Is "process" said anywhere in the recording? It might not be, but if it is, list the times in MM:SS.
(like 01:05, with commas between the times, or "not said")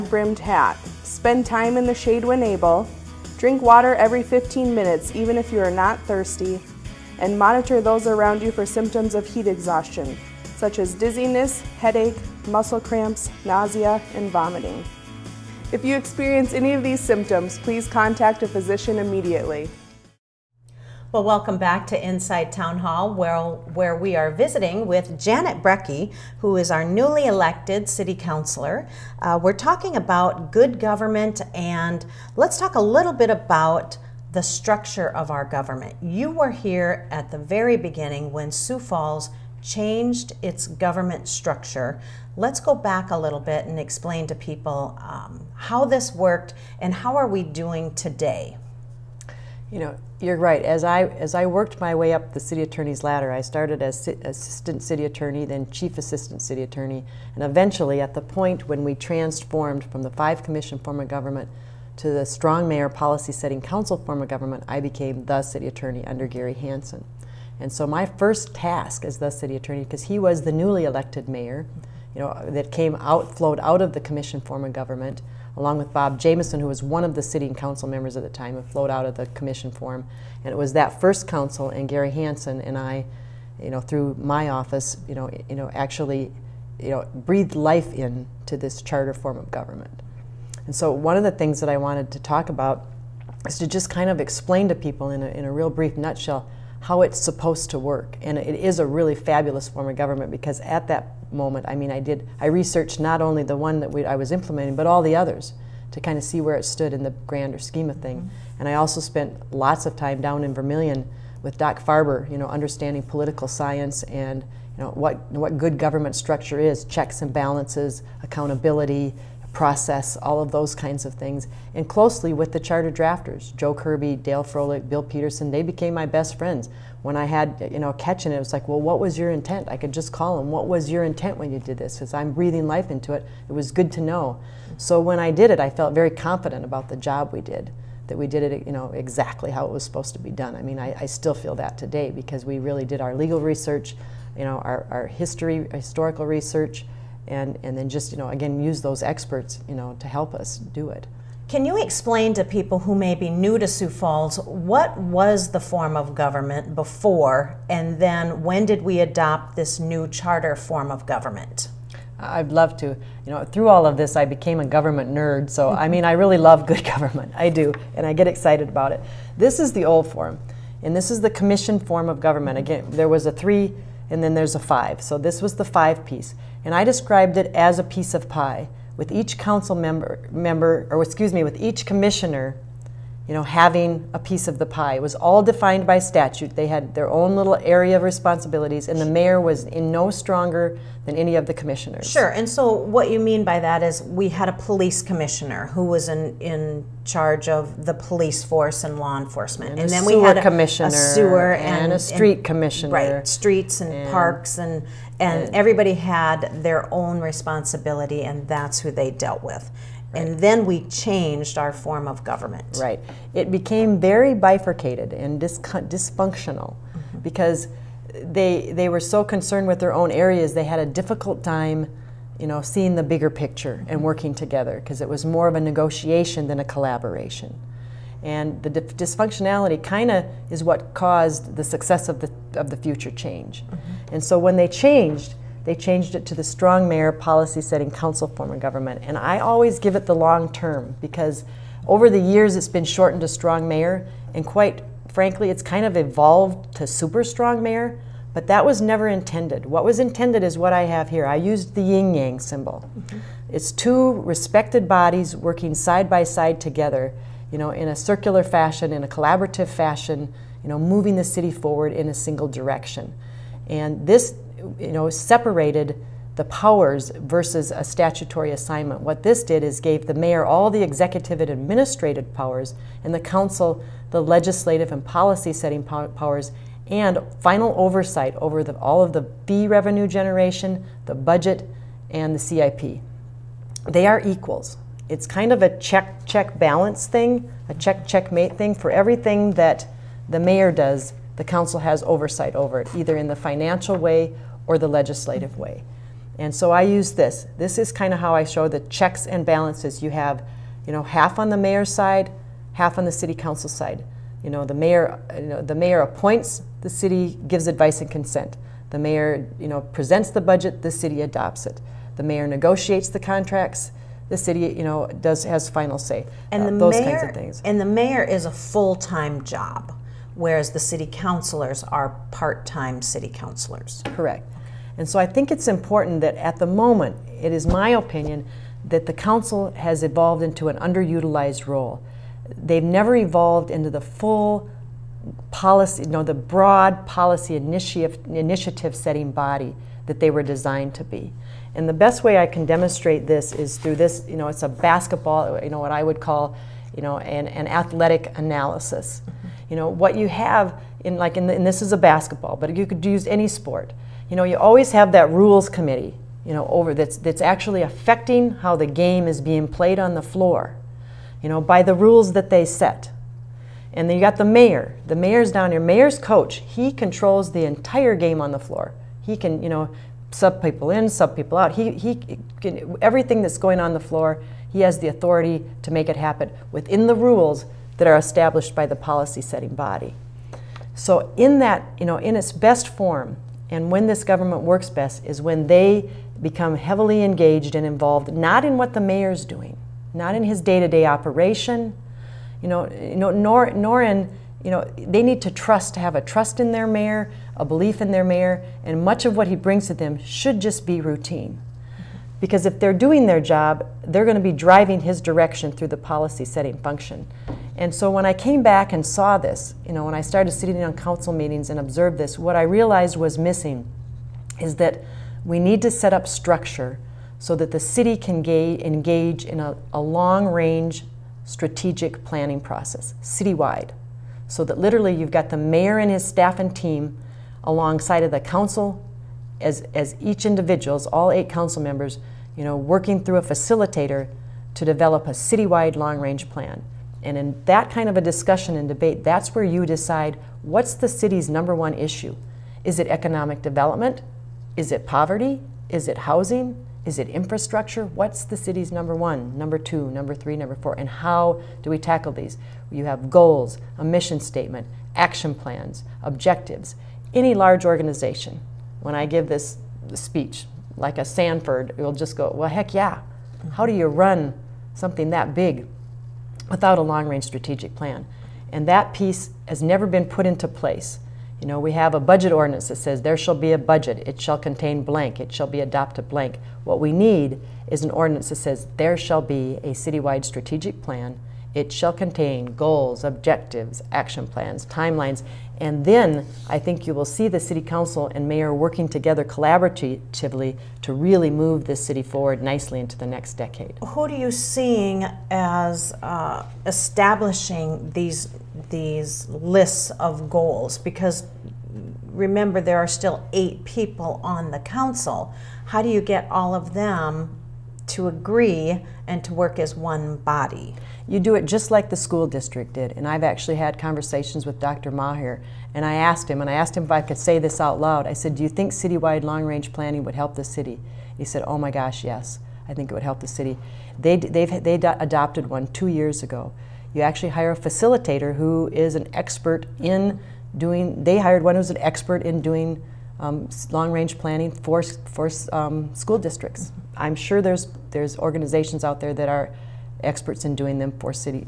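01:59, 07:02.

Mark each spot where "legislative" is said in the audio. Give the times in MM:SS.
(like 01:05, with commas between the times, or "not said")
04:34, 04:54.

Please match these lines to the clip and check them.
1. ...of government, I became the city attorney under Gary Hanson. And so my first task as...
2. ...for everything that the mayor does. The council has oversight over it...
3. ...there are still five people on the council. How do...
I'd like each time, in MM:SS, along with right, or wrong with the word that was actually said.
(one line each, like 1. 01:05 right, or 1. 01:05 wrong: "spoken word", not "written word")
1. 01:04 right
2. 04:48 right
3. 08:22 wrong: "eight", not "five".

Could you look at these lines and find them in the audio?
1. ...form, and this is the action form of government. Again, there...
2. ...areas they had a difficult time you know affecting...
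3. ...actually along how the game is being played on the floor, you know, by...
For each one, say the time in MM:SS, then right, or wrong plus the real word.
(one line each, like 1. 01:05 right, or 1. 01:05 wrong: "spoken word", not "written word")
1. 02:50 wrong: "commission", not "action"
2. 03:40 wrong: "seeing", not "affecting"
3. 05:57 wrong: "affecting", not "along".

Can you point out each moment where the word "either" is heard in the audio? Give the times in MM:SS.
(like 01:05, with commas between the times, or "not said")
04:52.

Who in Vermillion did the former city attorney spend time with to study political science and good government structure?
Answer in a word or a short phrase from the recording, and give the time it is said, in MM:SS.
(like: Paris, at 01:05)
Doc Farber, at 01:51.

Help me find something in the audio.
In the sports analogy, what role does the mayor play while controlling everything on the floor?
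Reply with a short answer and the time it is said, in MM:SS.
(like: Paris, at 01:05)
coach, at 06:05.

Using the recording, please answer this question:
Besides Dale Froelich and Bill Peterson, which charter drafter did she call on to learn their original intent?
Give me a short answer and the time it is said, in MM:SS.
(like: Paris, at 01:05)
Joe Kirby, at 02:03.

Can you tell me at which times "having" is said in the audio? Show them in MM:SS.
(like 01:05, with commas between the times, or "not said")
03:03.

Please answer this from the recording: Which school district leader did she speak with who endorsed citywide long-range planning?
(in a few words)
Dr. Maher.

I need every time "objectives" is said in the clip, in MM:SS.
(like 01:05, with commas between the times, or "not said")
07:36, 08:03.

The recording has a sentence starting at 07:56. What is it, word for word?
What we need is an ordinance that says there shall be a citywide strategic plan.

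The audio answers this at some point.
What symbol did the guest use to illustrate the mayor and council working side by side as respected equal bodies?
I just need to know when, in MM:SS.
04:11.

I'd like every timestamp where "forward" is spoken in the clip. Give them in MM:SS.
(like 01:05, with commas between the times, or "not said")
04:21, 08:12.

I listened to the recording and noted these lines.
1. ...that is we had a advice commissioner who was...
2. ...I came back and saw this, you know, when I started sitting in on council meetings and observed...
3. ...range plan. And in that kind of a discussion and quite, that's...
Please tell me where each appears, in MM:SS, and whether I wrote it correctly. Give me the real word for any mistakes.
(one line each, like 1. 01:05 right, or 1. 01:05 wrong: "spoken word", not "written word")
1. 03:13 wrong: "police", not "advice"
2. 06:48 right
3. 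07:16 wrong: "debate", not "quite".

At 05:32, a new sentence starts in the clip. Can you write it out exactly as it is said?
They've never evolved into the full policy, you know, the broad policy initiative, initiative setting body that they were designed to be.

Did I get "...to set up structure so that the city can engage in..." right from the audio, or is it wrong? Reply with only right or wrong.
right.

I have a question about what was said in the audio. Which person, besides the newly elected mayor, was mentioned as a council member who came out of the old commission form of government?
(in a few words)
Bob Jameson.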